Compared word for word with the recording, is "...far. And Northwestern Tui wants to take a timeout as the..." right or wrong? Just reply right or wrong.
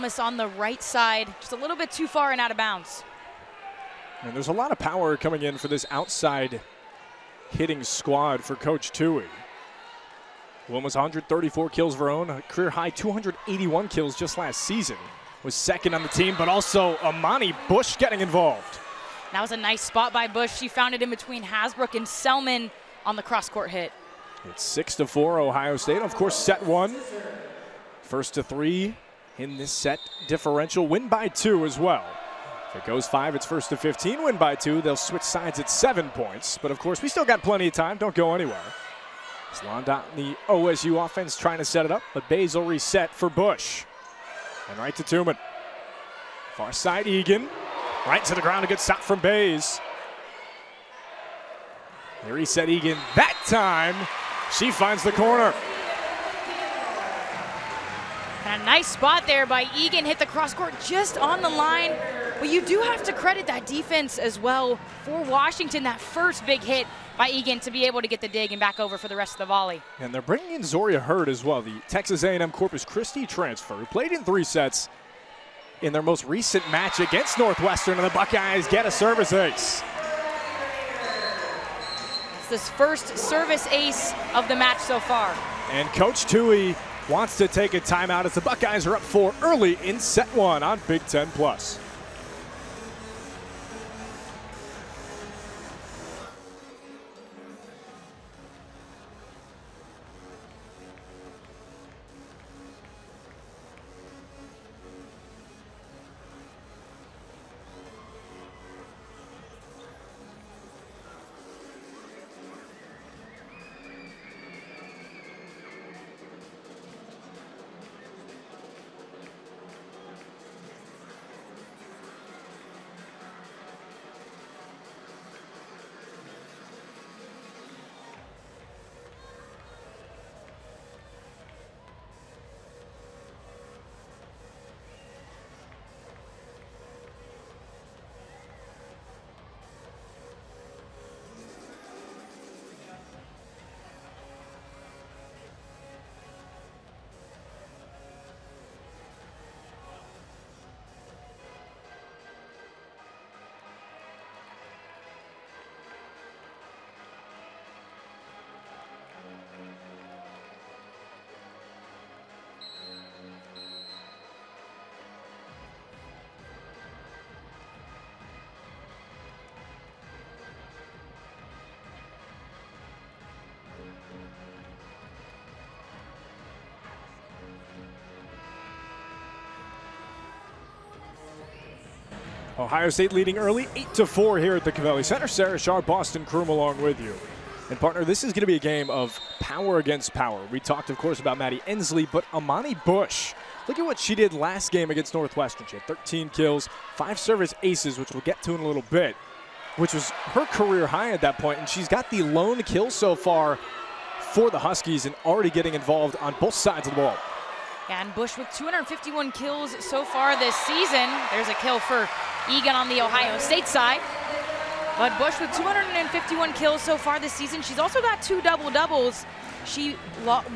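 wrong.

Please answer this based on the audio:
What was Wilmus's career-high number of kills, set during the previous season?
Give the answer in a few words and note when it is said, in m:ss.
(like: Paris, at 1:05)
281, at 0:12.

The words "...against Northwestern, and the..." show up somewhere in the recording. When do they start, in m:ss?
1:16.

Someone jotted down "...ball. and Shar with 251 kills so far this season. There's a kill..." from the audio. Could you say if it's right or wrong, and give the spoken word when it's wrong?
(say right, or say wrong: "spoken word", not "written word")
wrong: "Bush", not "Shar".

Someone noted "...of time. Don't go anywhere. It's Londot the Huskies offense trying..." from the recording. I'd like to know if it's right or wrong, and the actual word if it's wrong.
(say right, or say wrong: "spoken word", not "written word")
wrong: "OSU", not "Huskies".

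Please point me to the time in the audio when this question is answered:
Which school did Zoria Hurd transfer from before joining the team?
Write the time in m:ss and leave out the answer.
1:11.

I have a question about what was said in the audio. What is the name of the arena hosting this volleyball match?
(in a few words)
Covelli Center.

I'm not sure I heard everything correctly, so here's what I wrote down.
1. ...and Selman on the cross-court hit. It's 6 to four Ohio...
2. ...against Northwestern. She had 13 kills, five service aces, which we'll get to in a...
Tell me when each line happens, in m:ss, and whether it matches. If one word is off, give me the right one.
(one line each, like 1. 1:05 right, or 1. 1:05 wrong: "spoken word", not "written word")
1. 0:21 right
2. 3:14 right.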